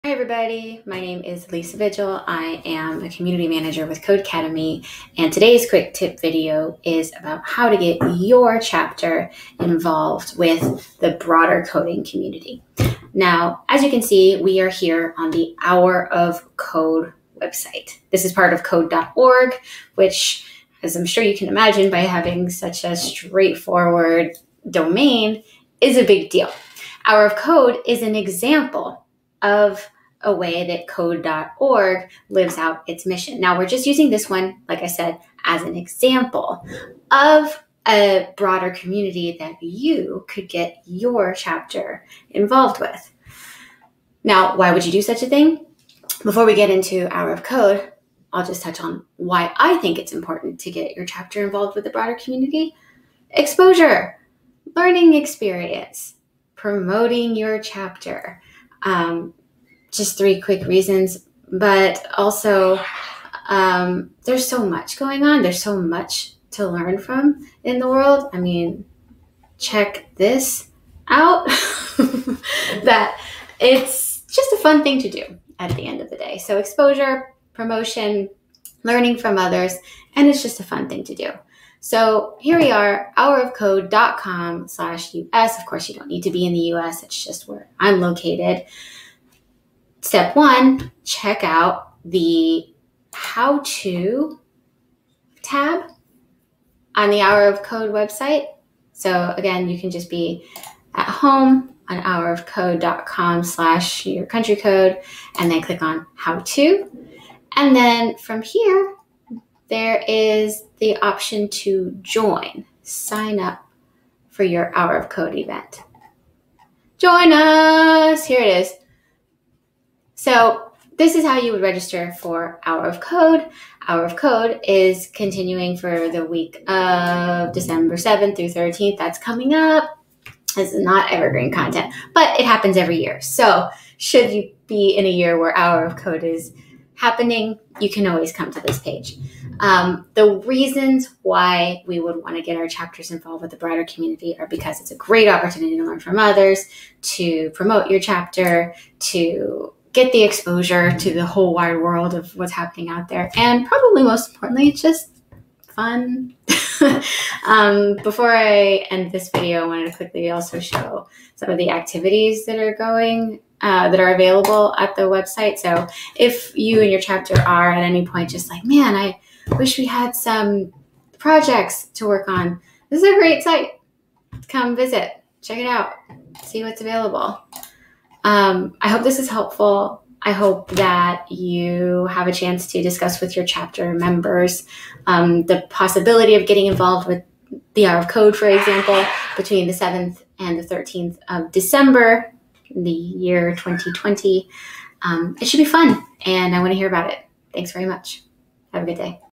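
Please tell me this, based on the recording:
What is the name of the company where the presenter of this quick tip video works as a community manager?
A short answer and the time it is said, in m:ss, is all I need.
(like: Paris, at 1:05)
Codecademy, at 0:04.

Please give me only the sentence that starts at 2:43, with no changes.
Uh, that are available at the website.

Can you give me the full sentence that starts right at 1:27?
It's just where I'm located step one, check out the how to tab on the Hour of Code website.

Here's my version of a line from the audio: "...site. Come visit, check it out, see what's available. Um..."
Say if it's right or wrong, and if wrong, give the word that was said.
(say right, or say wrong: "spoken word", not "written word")
right.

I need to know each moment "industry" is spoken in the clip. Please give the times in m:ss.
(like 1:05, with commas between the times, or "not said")
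not said.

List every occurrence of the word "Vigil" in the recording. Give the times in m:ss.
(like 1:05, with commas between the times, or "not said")
0:01.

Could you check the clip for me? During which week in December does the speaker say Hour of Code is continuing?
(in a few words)
December 7th through 13th.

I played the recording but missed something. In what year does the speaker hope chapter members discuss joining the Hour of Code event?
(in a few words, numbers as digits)
2020.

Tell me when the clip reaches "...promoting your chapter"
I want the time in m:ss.
0:56.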